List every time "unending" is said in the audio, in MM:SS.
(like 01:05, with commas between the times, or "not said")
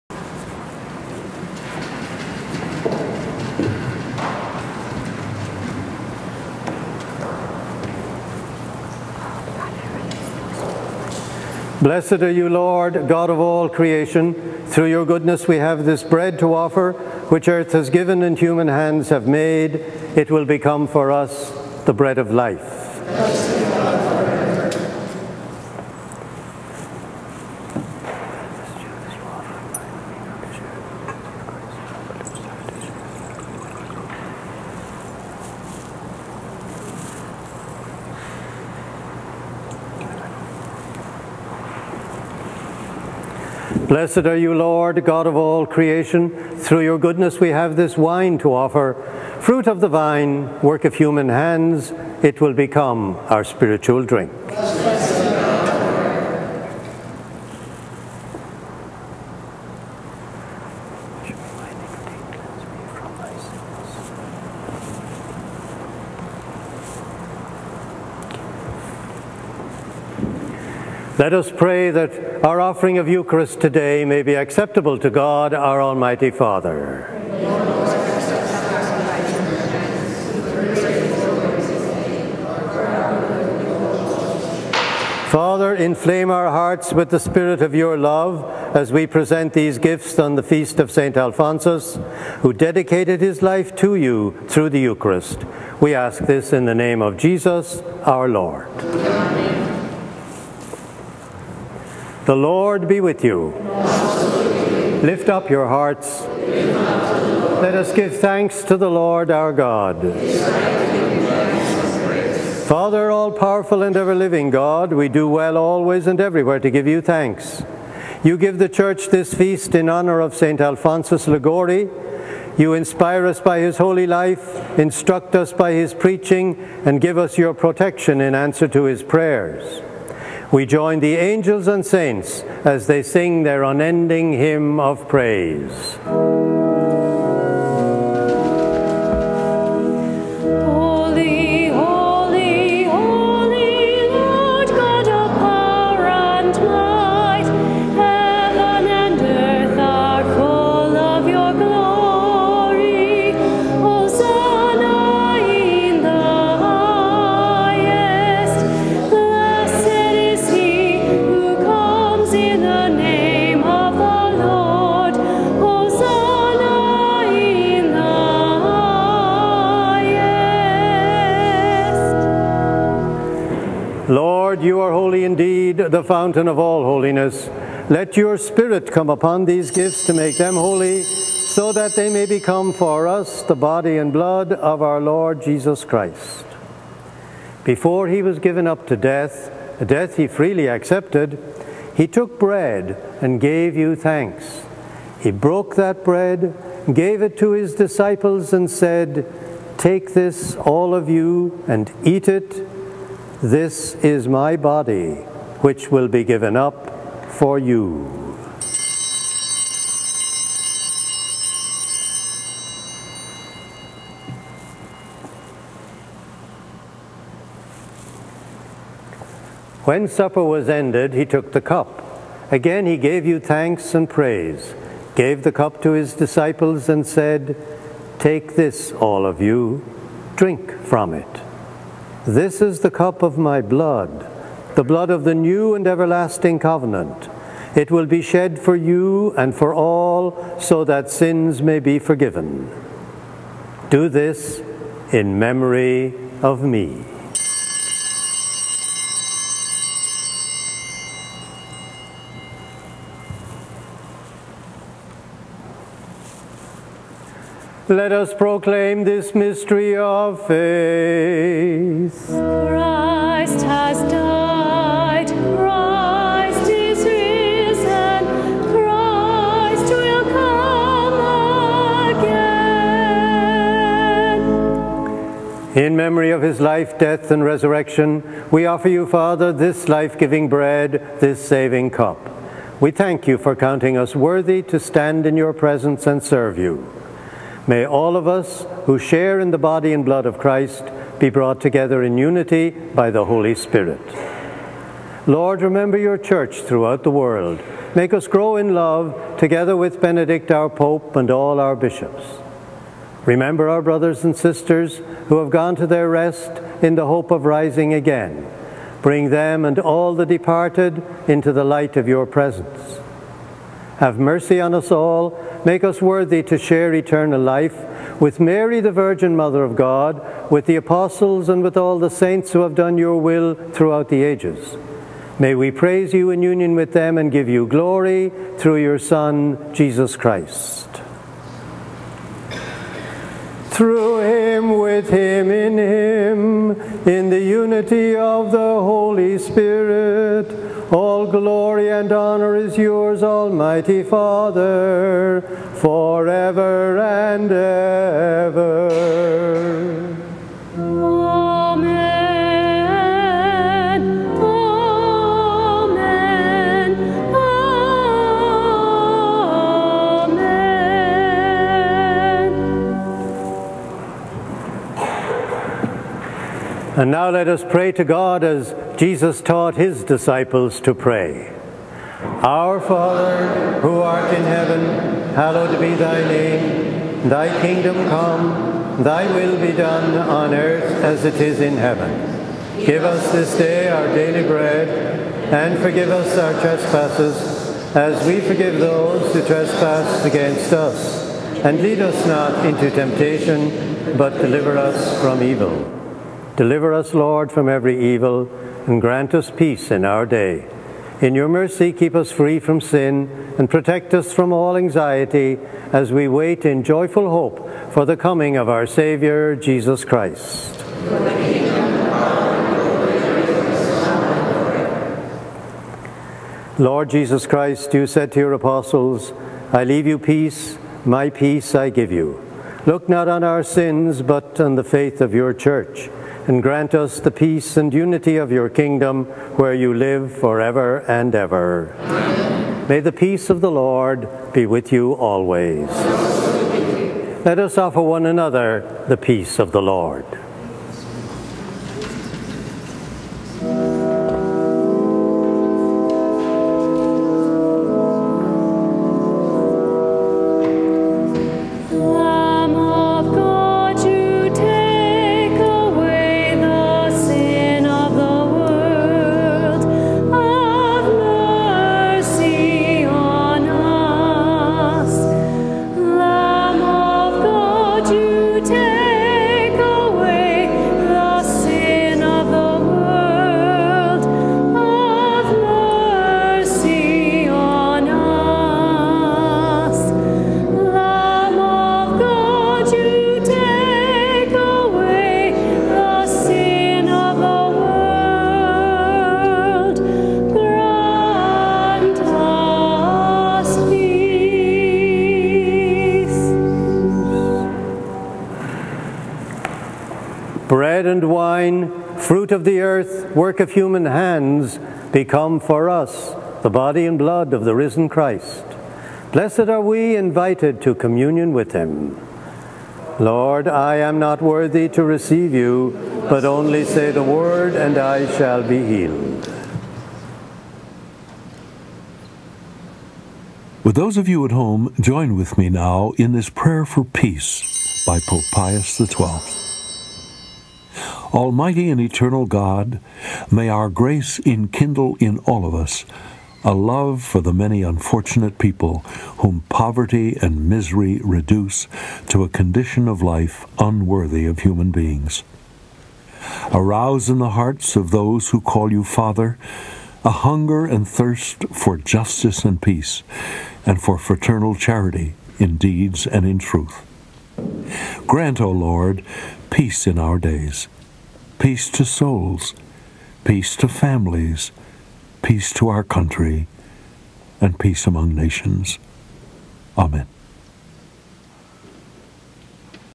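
02:13.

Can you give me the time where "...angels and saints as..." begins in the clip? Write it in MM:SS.
02:11.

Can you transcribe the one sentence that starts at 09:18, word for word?
Grant, O Lord, peace in our days peace to souls, peace to families, peace to our country, and peace among nations.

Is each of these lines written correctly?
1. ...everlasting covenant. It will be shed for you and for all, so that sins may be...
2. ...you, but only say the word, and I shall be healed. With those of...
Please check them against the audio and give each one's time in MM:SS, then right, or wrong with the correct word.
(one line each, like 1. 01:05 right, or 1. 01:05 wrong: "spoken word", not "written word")
1. 03:55 right
2. 08:35 right.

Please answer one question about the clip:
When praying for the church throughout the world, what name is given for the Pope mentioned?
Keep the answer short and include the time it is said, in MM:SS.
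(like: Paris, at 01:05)
Benedict, at 05:00.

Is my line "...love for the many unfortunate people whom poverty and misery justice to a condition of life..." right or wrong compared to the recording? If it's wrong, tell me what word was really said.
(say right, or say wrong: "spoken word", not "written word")
wrong: "reduce", not "justice".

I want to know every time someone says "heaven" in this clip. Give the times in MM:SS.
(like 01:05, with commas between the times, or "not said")
06:14, 06:21.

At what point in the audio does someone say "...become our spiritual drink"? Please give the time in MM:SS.
00:52.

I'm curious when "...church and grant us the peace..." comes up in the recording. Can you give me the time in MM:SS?
07:05.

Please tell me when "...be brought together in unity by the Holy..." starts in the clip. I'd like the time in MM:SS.
04:51.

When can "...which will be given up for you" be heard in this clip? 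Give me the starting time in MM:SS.
03:25.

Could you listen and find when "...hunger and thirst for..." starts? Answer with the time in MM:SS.
09:10.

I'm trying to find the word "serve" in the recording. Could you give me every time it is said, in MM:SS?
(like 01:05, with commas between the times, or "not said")
04:46.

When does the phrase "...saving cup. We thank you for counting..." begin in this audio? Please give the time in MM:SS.
04:41.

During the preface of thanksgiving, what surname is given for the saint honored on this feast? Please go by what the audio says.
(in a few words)
Liguori.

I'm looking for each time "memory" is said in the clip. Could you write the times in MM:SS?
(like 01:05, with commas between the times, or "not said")
04:05, 04:35.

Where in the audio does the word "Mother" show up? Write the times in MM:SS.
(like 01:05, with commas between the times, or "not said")
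05:19.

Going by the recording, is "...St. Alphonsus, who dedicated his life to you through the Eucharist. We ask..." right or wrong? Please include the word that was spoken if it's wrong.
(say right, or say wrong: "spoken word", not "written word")
right.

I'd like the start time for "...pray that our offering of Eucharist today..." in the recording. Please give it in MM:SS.
01:11.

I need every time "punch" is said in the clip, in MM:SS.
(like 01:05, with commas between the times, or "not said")
not said.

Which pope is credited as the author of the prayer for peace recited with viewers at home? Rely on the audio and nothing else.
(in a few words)
Pope Pius XII.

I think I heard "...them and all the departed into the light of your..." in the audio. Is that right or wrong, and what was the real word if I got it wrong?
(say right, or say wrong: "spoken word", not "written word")
right.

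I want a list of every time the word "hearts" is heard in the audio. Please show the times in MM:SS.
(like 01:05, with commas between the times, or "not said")
01:26, 01:45, 09:07.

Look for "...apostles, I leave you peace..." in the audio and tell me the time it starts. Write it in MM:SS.
06:58.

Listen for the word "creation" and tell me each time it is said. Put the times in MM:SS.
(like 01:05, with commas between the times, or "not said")
00:13, 00:45.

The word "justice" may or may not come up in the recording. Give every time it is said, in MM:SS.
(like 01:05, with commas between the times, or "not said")
09:11.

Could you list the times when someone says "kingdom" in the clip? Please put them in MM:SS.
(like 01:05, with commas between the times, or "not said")
06:17, 07:08.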